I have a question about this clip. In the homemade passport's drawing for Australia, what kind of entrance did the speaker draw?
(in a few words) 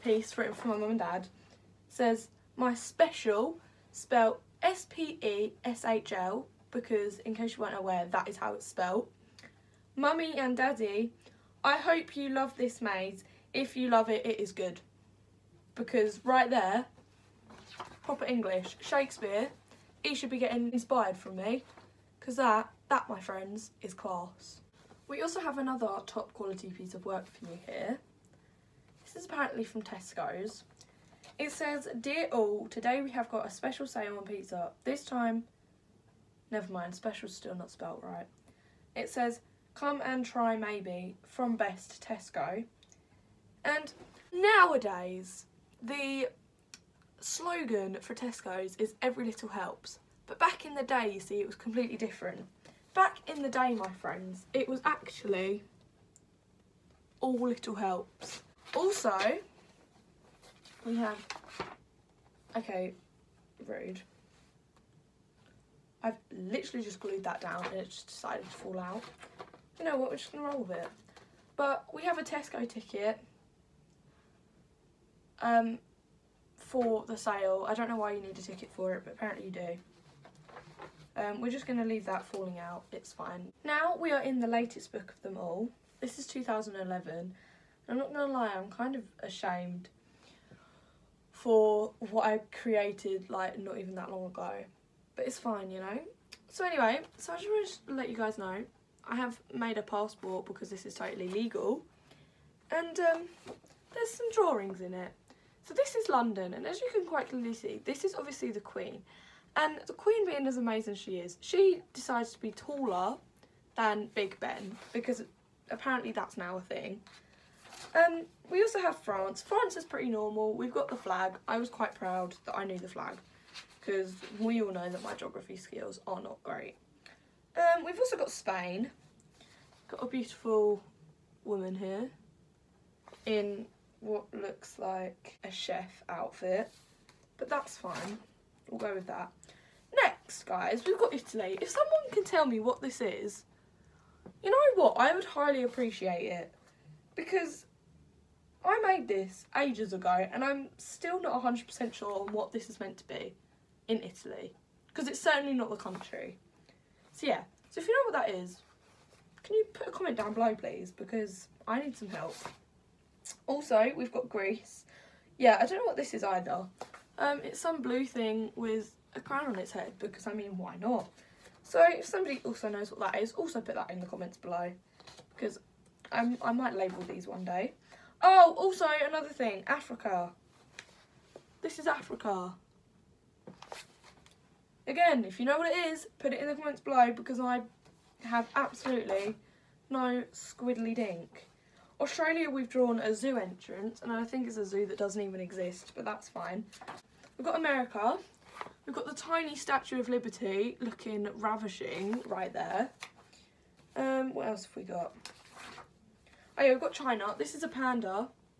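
a zoo entrance.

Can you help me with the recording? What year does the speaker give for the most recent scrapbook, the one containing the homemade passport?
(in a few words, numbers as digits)
2011.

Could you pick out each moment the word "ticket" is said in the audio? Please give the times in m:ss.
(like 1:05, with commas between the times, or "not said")
1:12, 1:18.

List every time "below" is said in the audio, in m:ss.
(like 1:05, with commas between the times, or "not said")
2:40, 2:54, 3:06.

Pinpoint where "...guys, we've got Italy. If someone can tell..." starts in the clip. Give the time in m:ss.
2:20.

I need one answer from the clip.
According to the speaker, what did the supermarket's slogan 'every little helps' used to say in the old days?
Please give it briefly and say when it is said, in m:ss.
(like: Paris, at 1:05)
all little helps, at 0:57.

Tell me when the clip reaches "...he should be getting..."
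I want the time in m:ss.
0:20.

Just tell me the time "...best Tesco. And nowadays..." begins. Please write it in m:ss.
0:41.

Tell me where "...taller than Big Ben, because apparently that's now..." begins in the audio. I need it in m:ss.
1:52.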